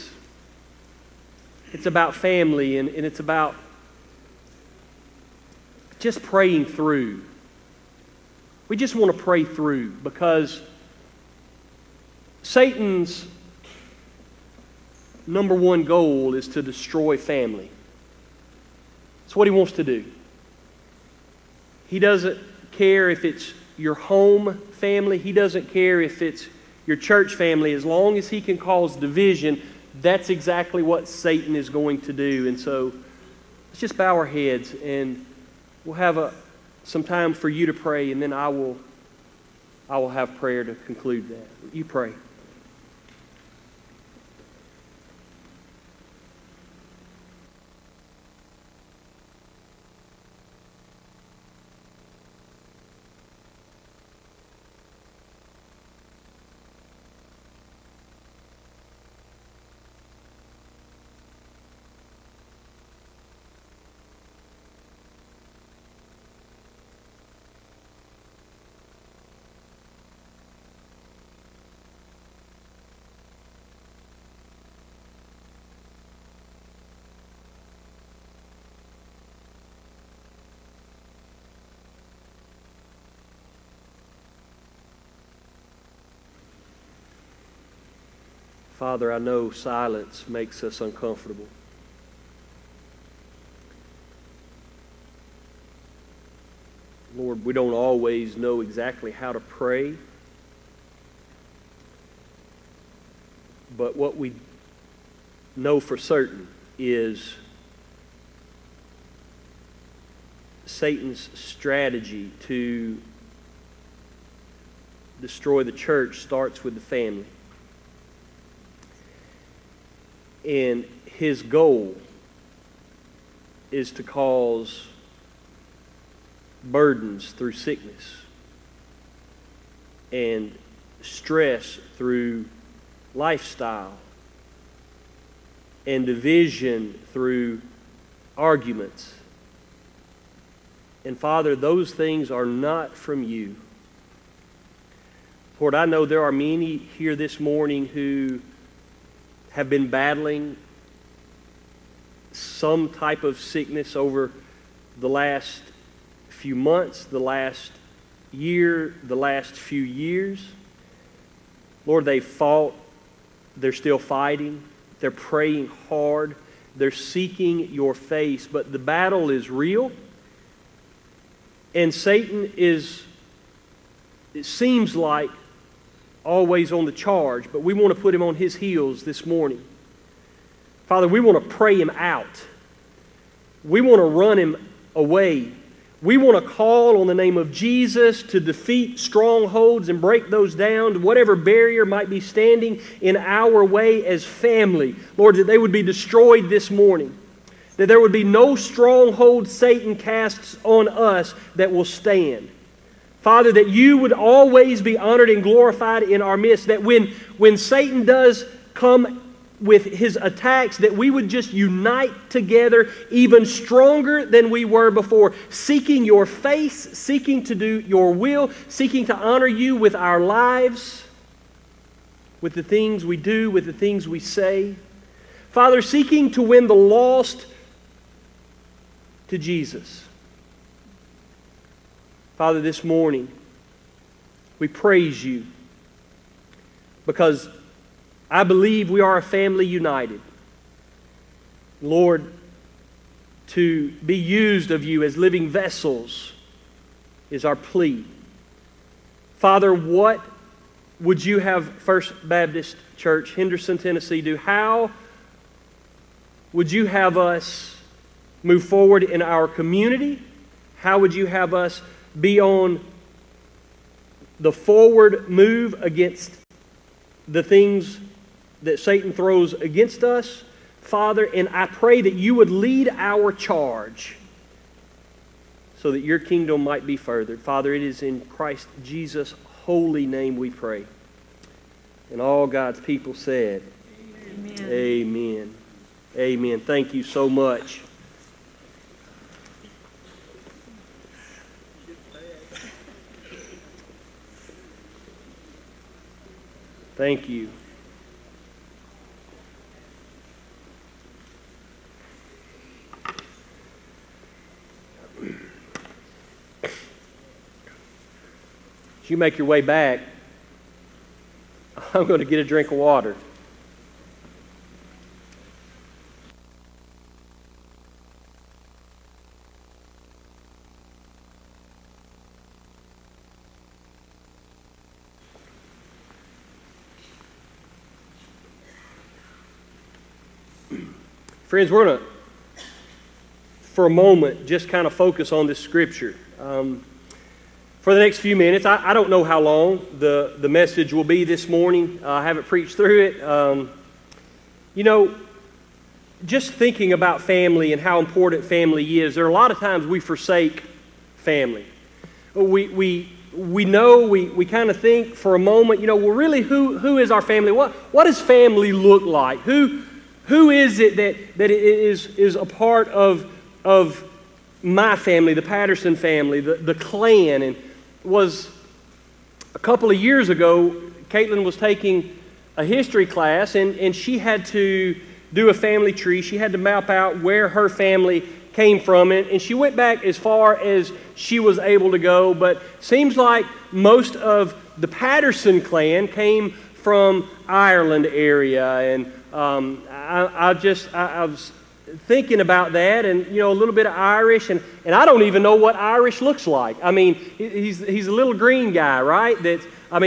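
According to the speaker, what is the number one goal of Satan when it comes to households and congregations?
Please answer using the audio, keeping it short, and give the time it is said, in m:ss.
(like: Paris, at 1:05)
Destroy family, at 0:16.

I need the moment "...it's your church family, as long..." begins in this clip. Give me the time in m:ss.
0:26.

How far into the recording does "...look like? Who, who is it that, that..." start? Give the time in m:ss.
5:58.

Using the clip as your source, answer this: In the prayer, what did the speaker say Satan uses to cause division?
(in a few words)
Arguments.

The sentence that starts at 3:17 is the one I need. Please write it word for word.
That there would be no stronghold Satan casts on us that will stand.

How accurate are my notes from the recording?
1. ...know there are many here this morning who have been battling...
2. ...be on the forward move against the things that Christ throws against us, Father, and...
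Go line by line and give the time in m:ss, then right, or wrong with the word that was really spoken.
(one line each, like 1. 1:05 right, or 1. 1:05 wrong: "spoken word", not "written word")
1. 2:25 right
2. 4:22 wrong: "Satan", not "Christ".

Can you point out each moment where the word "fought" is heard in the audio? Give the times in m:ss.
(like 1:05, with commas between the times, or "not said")
2:42.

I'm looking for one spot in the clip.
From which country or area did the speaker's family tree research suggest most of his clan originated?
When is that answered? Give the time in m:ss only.
6:27.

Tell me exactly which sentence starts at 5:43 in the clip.
Um, you know, just thinking about family and how important family is, there are a lot of times we forsake family.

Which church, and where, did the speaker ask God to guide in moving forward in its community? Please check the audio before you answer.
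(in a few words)
First Baptist Church, Henderson, Tennessee.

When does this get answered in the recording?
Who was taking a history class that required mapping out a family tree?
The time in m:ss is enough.
6:11.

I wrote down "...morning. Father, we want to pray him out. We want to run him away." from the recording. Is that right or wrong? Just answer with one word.
right.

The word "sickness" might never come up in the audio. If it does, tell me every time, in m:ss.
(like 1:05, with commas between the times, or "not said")
2:07, 2:33.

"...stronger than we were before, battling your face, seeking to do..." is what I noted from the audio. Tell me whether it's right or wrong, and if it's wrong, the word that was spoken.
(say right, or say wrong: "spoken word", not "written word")
wrong: "seeking", not "battling".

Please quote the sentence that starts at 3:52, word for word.
Father, this morning, we praise you because I believe we are a family united.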